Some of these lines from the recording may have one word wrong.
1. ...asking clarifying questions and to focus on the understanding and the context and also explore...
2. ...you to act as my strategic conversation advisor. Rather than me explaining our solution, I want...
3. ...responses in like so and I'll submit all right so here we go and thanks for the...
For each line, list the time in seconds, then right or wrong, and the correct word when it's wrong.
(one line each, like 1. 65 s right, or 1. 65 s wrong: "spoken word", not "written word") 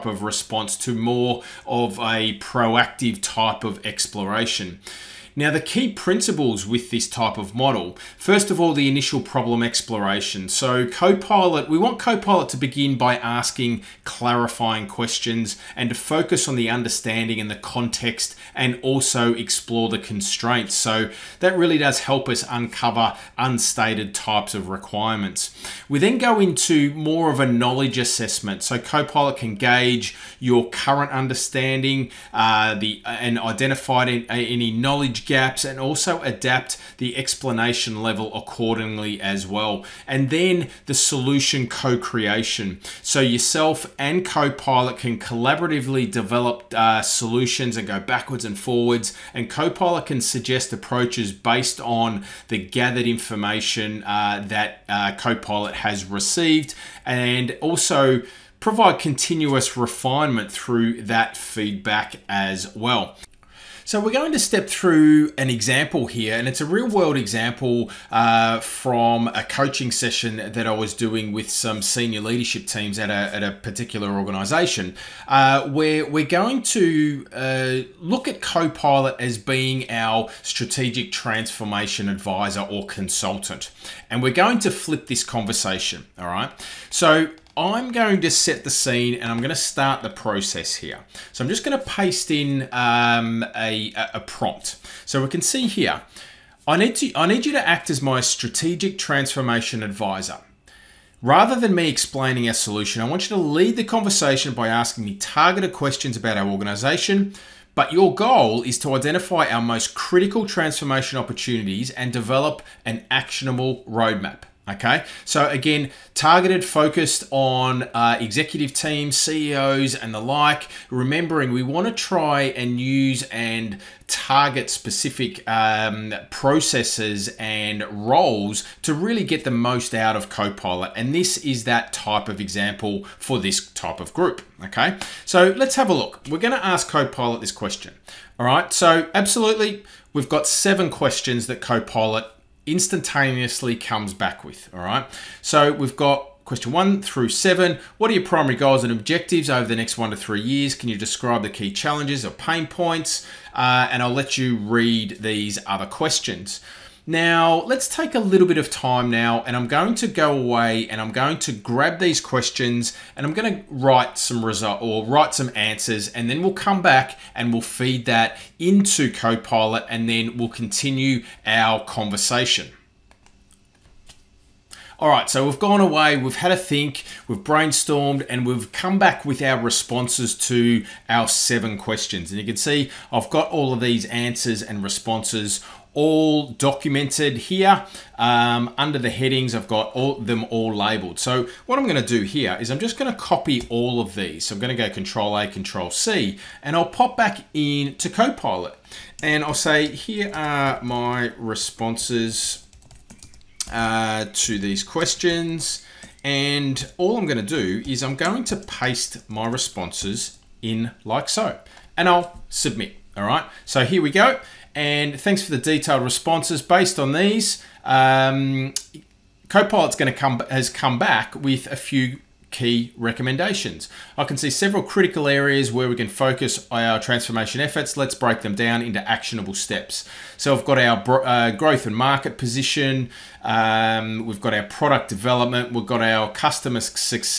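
1. 13 s right
2. 97 s wrong: "transformation", not "conversation"
3. 209 s right.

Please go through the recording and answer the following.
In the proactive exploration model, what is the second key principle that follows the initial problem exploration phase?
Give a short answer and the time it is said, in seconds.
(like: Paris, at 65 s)
Knowledge assessment, at 27 s.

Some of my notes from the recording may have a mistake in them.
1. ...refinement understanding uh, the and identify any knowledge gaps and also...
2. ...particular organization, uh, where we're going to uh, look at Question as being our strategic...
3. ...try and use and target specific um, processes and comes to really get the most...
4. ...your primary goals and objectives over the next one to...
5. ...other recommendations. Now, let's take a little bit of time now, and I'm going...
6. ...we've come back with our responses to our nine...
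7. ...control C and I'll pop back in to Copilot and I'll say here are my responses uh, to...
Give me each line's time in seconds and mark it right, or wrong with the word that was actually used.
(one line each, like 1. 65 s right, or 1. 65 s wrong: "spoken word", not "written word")
1. 30 s wrong: "current", not "refinement"
2. 73 s wrong: "Copilot", not "Question"
3. 121 s wrong: "roles", not "comes"
4. 148 s right
5. 155 s wrong: "questions", not "recommendations"
6. 178 s wrong: "seven", not "nine"
7. 195 s right.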